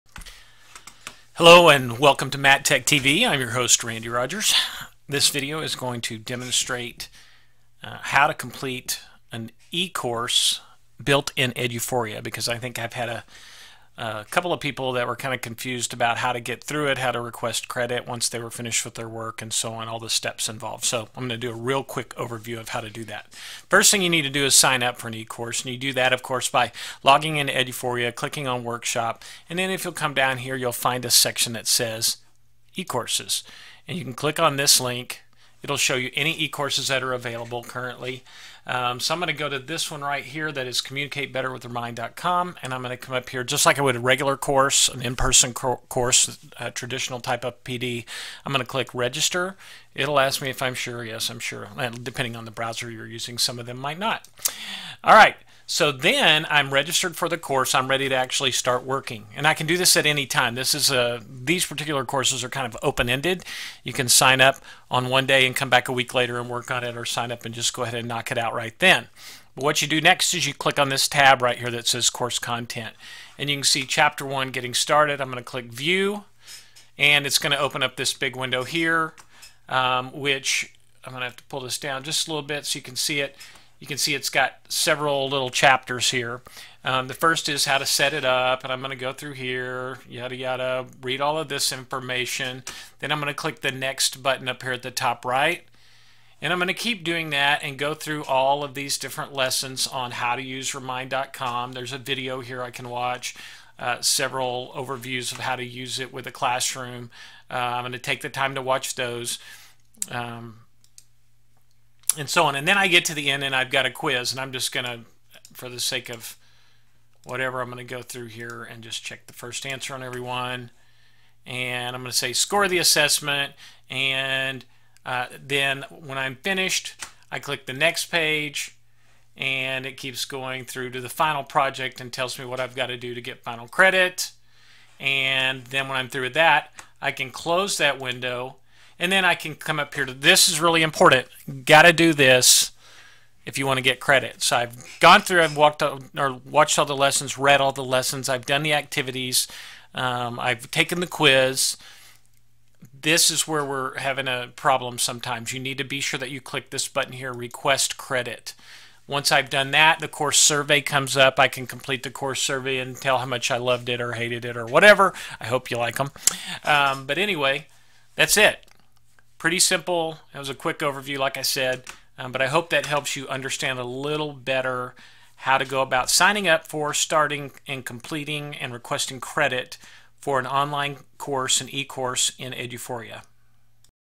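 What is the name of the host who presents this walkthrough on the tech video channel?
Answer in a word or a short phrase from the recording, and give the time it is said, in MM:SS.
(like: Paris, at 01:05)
Randy Rodgers, at 00:03.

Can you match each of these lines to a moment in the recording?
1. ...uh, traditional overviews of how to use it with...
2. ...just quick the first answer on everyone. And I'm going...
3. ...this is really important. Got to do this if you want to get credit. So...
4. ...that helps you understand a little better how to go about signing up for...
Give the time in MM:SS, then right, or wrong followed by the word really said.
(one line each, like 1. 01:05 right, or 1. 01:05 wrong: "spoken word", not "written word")
1. 01:43 wrong: "several", not "traditional"
2. 01:58 wrong: "check", not "quick"
3. 02:20 right
4. 02:52 right.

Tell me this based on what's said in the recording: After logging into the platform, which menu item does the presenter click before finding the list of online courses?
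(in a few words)
Workshop.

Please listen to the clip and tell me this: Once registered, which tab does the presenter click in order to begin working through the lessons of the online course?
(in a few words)
course content.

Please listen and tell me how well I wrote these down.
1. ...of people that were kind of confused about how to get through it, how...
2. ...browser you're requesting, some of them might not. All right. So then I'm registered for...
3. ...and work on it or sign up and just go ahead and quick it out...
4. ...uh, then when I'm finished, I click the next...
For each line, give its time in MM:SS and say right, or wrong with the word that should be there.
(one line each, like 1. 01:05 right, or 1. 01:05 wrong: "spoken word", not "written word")
1. 00:14 right
2. 00:52 wrong: "using", not "requesting"
3. 01:06 wrong: "knock", not "quick"
4. 02:05 right.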